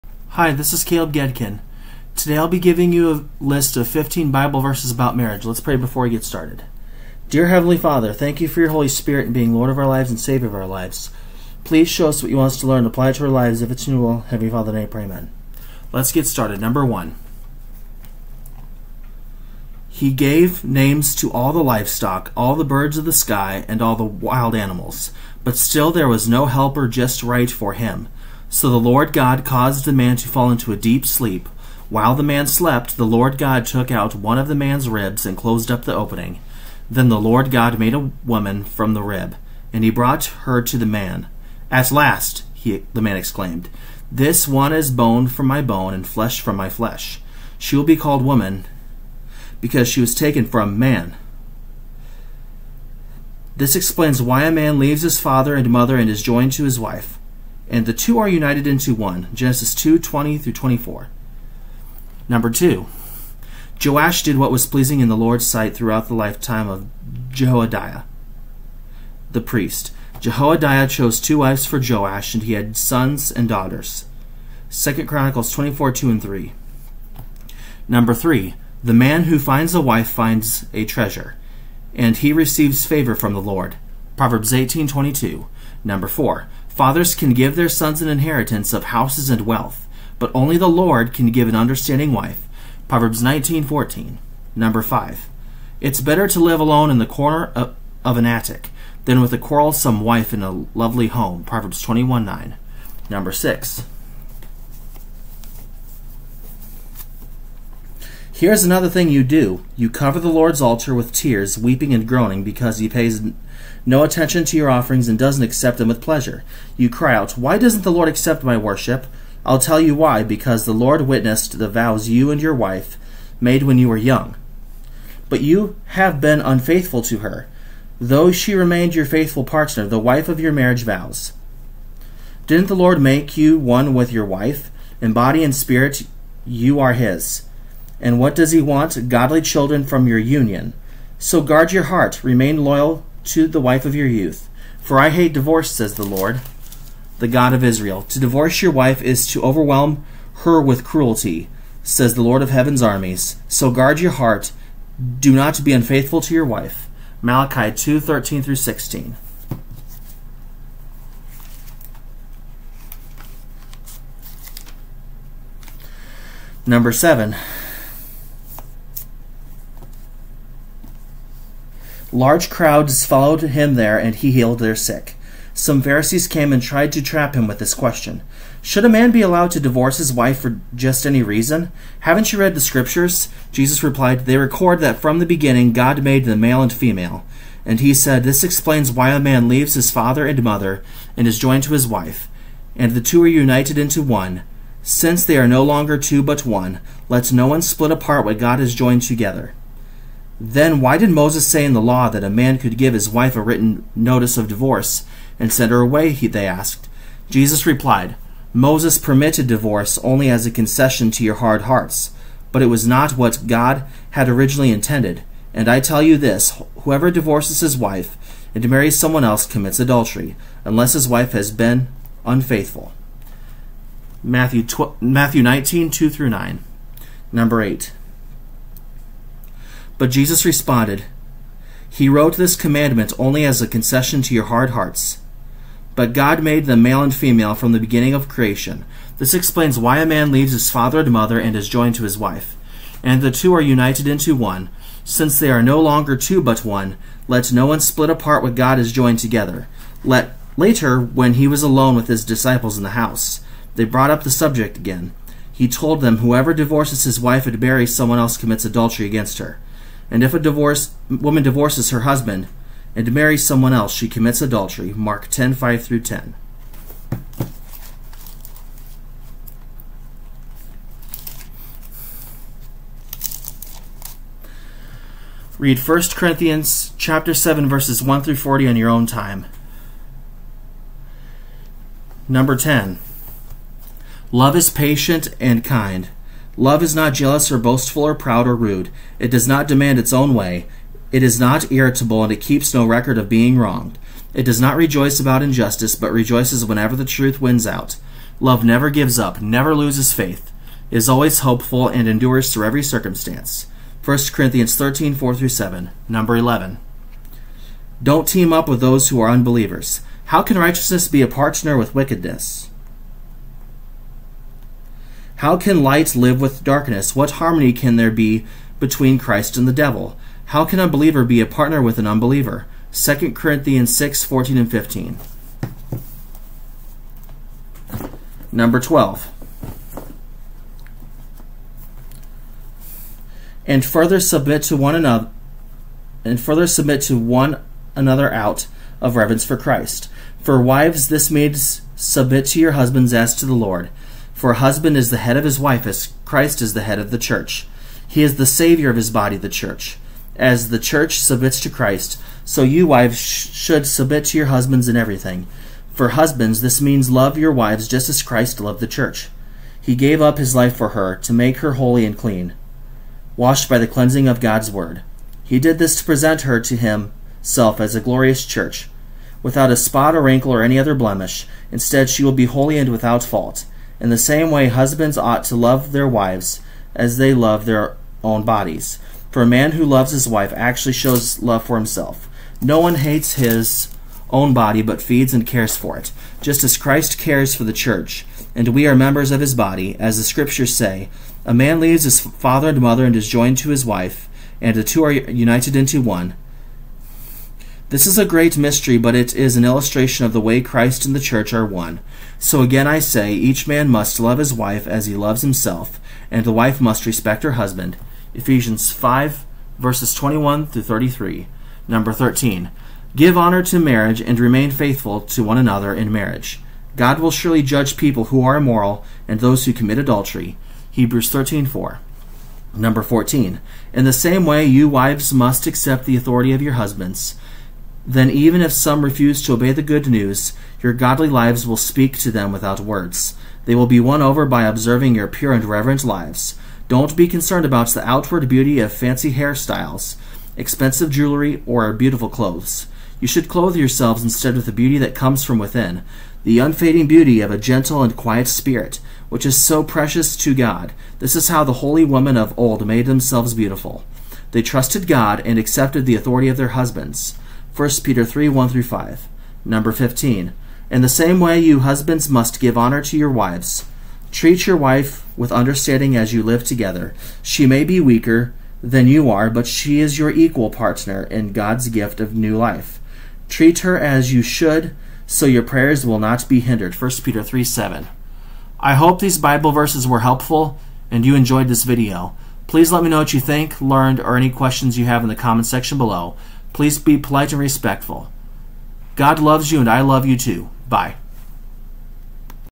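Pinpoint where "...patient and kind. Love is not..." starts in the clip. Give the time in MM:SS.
04:44.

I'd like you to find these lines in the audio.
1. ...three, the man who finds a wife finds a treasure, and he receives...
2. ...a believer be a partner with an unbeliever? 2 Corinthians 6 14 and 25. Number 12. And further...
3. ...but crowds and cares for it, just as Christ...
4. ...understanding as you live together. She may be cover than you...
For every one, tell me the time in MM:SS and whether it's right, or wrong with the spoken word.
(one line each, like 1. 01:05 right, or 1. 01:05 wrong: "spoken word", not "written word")
1. 01:18 right
2. 05:20 wrong: "15", not "25"
3. 06:24 wrong: "feeds", not "crowds"
4. 07:45 wrong: "weaker", not "cover".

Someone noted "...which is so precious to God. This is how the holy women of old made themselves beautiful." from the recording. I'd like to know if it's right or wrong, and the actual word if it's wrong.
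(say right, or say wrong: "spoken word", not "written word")
right.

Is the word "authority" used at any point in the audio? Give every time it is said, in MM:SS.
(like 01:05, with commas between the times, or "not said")
07:06, 07:36.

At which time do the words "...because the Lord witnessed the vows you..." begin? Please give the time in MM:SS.
02:00.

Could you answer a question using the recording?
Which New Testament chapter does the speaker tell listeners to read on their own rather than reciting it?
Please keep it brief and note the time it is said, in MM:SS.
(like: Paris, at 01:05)
1 Corinthians 7, at 04:35.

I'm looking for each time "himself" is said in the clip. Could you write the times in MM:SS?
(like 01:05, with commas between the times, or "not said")
06:06, 06:21, 06:45.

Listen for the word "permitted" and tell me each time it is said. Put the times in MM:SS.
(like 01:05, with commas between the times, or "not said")
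03:28.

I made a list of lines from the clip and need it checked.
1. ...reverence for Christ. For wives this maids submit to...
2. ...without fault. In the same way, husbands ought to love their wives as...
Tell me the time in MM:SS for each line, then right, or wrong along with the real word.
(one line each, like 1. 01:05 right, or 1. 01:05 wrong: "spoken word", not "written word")
1. 05:39 right
2. 06:12 right.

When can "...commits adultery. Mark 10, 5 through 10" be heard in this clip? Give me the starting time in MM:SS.
04:24.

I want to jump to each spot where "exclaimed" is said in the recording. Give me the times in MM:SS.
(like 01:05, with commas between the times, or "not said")
00:43.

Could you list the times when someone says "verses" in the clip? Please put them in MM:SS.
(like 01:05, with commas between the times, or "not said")
00:04, 04:37, 06:49, 07:59.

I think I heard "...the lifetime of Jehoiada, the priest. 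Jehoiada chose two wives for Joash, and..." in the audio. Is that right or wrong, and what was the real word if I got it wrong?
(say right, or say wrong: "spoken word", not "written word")
right.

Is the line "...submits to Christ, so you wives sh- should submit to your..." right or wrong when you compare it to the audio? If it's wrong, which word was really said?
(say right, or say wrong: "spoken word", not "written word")
right.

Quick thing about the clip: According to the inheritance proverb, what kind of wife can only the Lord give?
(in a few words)
an understanding wife.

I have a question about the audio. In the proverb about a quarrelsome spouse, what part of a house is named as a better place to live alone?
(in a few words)
the corner of an attic.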